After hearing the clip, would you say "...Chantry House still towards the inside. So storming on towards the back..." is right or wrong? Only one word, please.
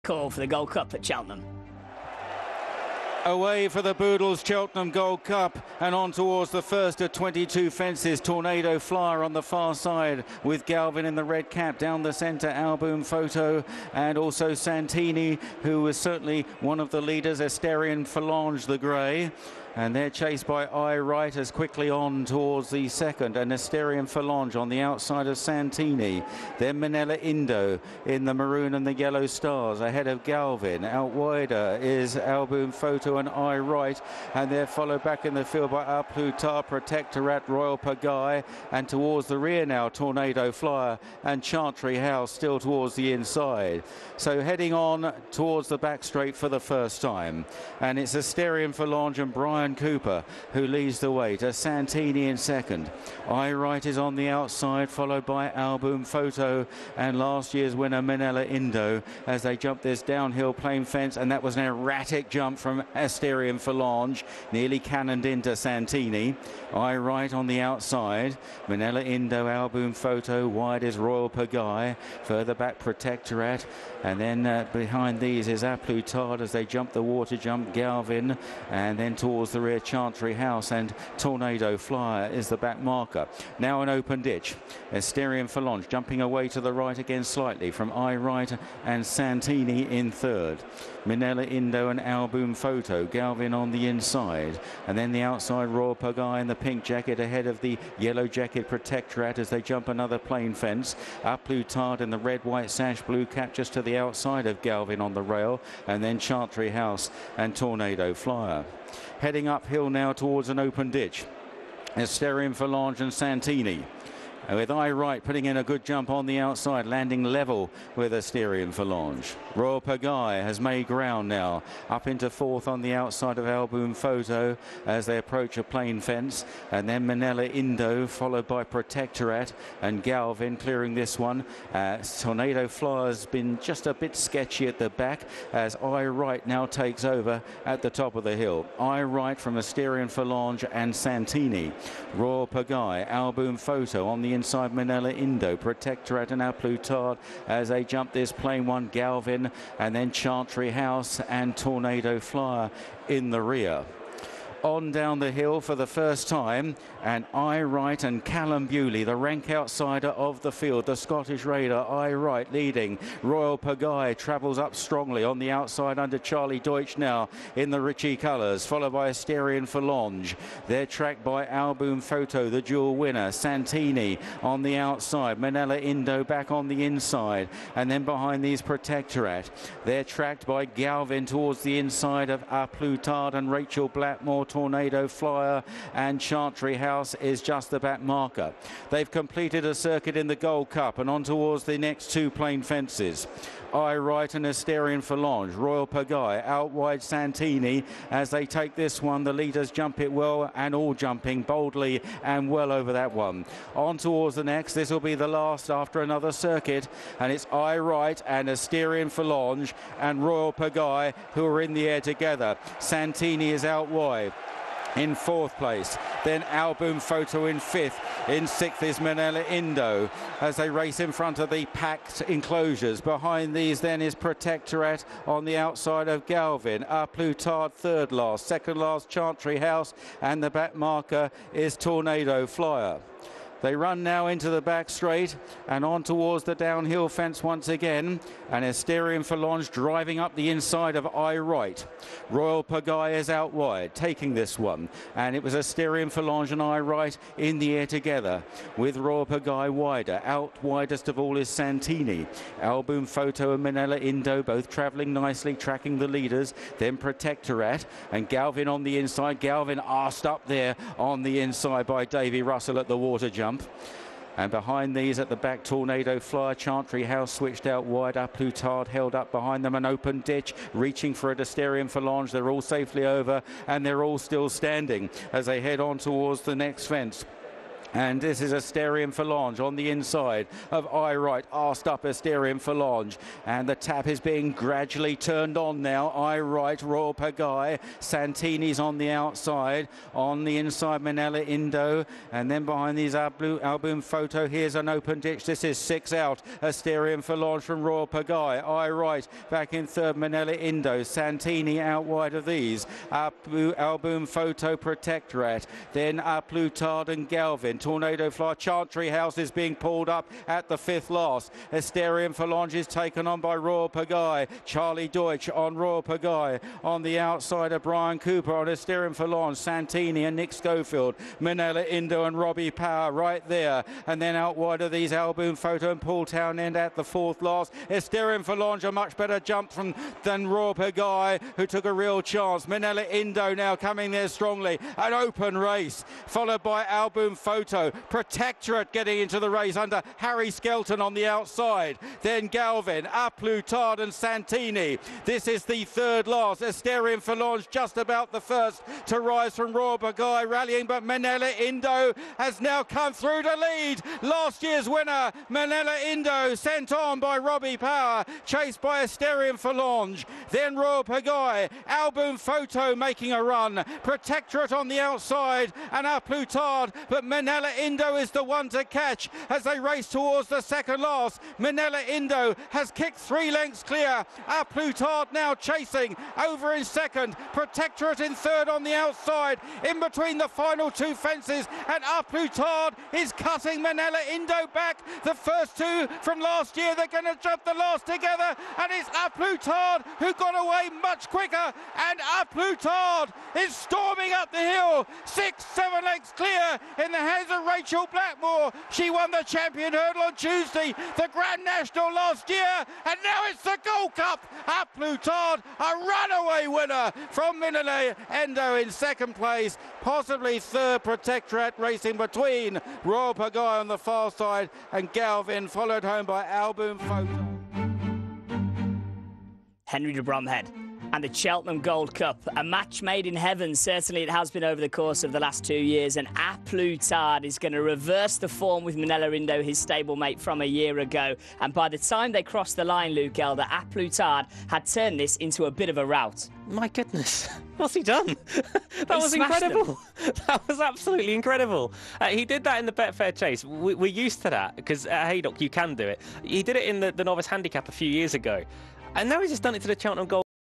wrong.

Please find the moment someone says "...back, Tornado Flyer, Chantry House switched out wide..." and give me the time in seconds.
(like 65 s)
265 s.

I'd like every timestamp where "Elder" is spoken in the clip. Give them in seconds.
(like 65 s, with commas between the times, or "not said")
433 s.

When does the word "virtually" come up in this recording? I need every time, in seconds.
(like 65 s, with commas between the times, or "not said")
not said.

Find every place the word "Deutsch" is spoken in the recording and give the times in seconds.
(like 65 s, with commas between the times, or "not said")
166 s, 315 s.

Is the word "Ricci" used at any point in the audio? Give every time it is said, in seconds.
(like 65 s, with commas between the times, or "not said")
167 s.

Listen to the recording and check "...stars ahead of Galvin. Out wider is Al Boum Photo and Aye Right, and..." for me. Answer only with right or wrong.
right.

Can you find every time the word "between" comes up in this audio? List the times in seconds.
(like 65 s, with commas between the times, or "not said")
379 s, 412 s.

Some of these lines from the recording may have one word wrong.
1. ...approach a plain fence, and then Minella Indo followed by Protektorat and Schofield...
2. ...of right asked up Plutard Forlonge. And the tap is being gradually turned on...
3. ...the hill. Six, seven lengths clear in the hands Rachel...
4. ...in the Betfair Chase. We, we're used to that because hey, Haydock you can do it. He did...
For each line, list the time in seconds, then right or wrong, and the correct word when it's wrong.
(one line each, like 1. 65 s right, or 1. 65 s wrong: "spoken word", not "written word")
1. 125 s wrong: "Galvin", not "Schofield"
2. 280 s wrong: "Asterion", not "Plutard"
3. 394 s right
4. 442 s right.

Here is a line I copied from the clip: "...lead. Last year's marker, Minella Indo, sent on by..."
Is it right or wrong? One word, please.
wrong.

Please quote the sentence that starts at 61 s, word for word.
And that was an erratic jump from Asterion Forlonge, nearly cannoned into Santini.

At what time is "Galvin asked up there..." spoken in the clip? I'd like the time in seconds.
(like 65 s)
259 s.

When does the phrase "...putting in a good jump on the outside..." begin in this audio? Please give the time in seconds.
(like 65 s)
115 s.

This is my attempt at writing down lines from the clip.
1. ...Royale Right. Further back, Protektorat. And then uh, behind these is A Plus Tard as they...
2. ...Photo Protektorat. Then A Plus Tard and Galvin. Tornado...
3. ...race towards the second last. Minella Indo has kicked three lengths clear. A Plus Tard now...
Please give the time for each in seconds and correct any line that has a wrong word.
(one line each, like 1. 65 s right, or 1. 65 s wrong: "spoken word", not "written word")
1. 70 s wrong: "Pagaille", not "Right"
2. 304 s right
3. 369 s right.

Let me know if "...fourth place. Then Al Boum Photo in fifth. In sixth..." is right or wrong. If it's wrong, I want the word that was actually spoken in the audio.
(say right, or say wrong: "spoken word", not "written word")
right.